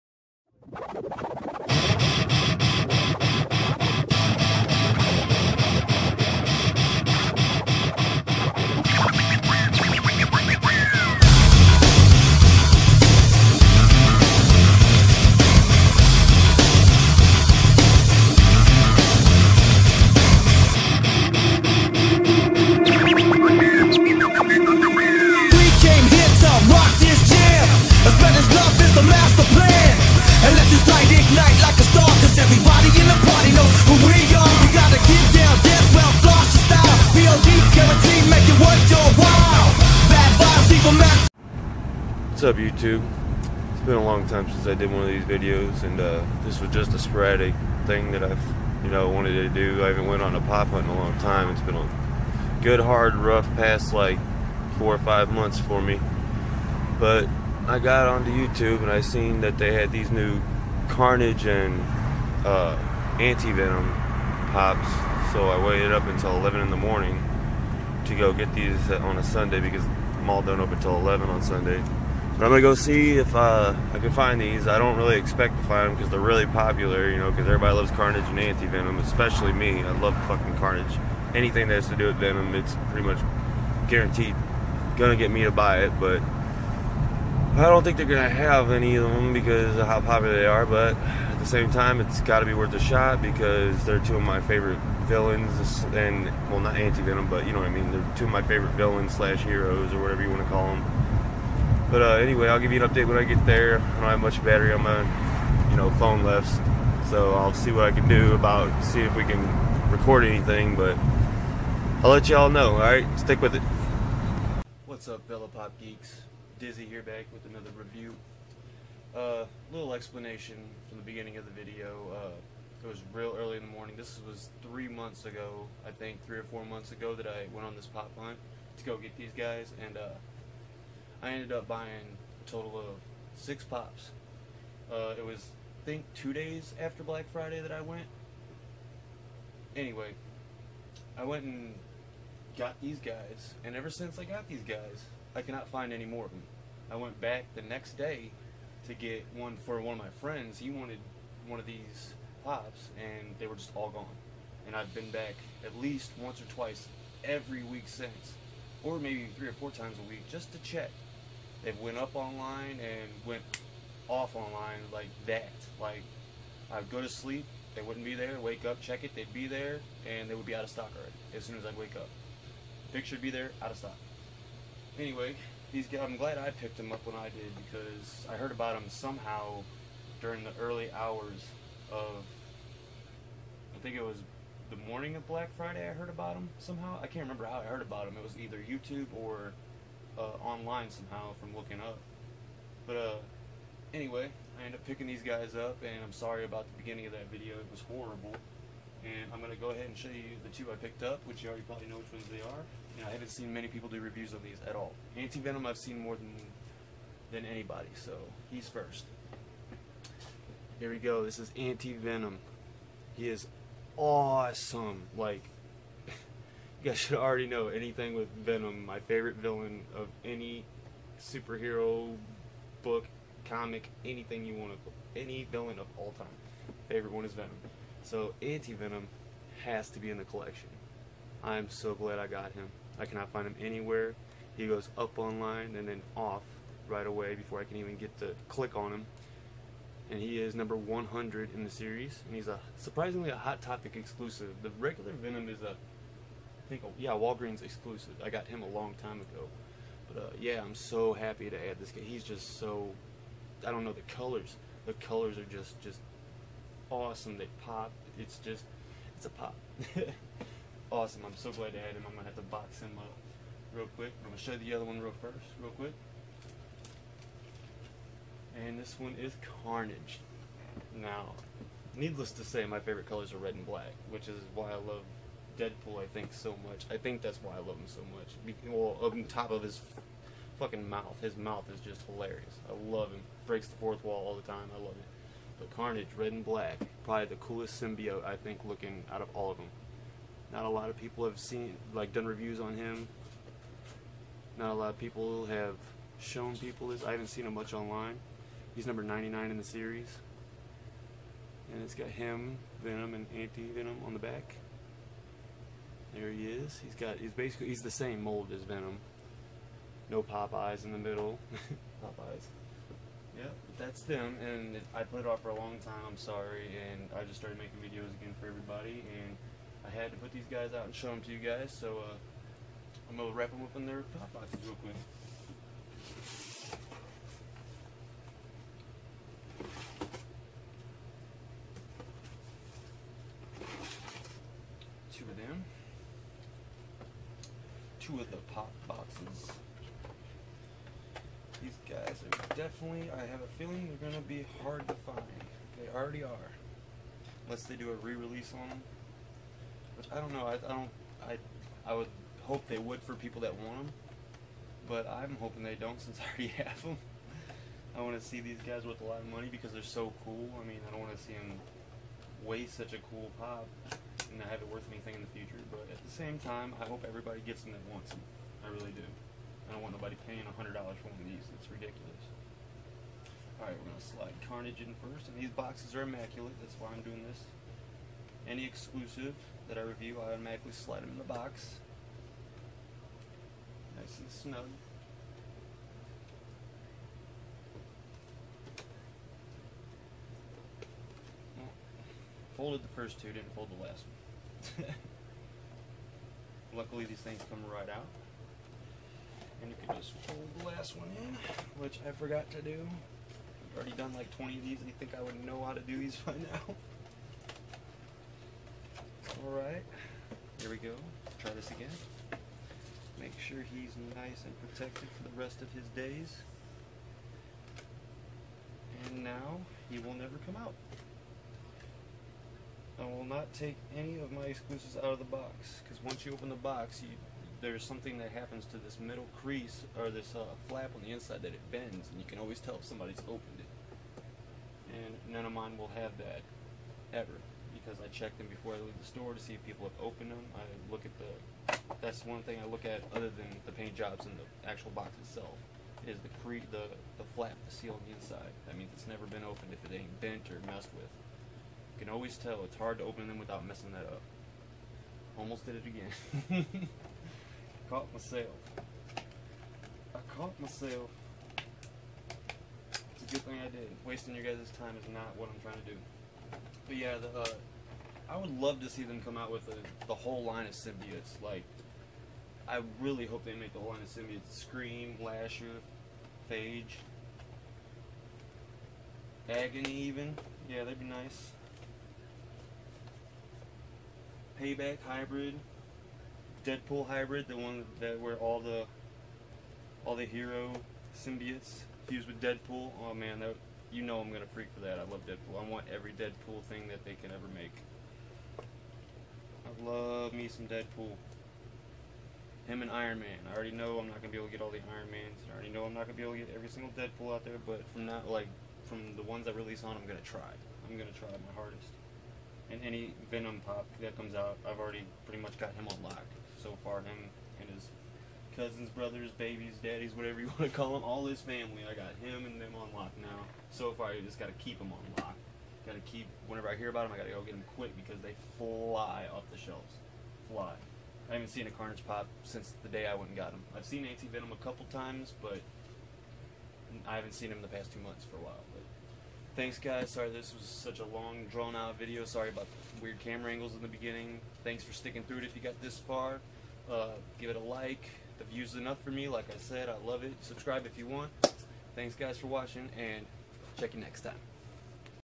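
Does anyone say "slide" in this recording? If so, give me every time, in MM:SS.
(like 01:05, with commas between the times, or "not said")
06:14, 06:20.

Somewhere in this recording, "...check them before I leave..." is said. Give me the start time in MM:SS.
07:18.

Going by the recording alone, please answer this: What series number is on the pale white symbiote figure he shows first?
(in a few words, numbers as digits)
100.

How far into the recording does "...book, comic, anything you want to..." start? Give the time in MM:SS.
03:42.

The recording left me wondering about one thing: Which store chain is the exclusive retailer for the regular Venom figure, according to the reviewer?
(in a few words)
Walgreens.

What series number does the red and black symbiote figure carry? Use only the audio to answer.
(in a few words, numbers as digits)
99.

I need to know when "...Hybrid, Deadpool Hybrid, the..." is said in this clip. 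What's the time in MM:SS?
08:05.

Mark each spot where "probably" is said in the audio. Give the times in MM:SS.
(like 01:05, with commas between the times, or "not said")
03:21, 04:47.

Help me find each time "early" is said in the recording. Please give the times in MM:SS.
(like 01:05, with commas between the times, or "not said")
02:03, 03:00.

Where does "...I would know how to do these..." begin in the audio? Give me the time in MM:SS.
06:45.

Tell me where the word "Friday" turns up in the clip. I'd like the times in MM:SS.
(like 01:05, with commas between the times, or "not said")
02:17, 03:05.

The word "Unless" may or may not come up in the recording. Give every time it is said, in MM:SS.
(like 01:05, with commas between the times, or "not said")
05:47.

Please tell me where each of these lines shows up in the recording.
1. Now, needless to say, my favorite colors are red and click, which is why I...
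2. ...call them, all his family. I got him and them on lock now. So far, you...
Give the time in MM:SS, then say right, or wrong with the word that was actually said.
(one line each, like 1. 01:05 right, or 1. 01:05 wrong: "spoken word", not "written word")
1. 04:30 wrong: "black", not "click"
2. 08:40 right.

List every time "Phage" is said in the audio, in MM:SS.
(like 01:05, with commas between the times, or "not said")
07:56.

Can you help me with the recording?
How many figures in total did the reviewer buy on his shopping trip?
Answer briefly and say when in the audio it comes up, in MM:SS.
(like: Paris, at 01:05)
6, at 02:13.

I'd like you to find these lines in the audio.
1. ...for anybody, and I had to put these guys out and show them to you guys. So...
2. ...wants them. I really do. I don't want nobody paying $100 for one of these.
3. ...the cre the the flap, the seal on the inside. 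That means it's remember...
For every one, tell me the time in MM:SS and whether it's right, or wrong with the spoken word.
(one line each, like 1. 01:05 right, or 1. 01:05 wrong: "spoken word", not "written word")
1. 05:18 wrong: "everybody", not "anybody"
2. 06:07 right
3. 07:26 wrong: "never", not "remember".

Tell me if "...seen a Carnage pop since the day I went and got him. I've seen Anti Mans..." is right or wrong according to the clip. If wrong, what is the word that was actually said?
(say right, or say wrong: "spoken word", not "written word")
wrong: "Venom", not "Mans".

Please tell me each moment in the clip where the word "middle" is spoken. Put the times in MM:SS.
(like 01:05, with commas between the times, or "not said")
05:10, 07:08.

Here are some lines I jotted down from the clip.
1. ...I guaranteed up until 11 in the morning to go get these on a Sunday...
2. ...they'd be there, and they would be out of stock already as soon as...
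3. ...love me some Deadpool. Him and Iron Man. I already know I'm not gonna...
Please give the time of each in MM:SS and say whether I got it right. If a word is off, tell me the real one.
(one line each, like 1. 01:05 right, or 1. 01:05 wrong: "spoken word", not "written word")
1. 01:05 wrong: "waited", not "guaranteed"
2. 02:49 right
3. 08:19 right.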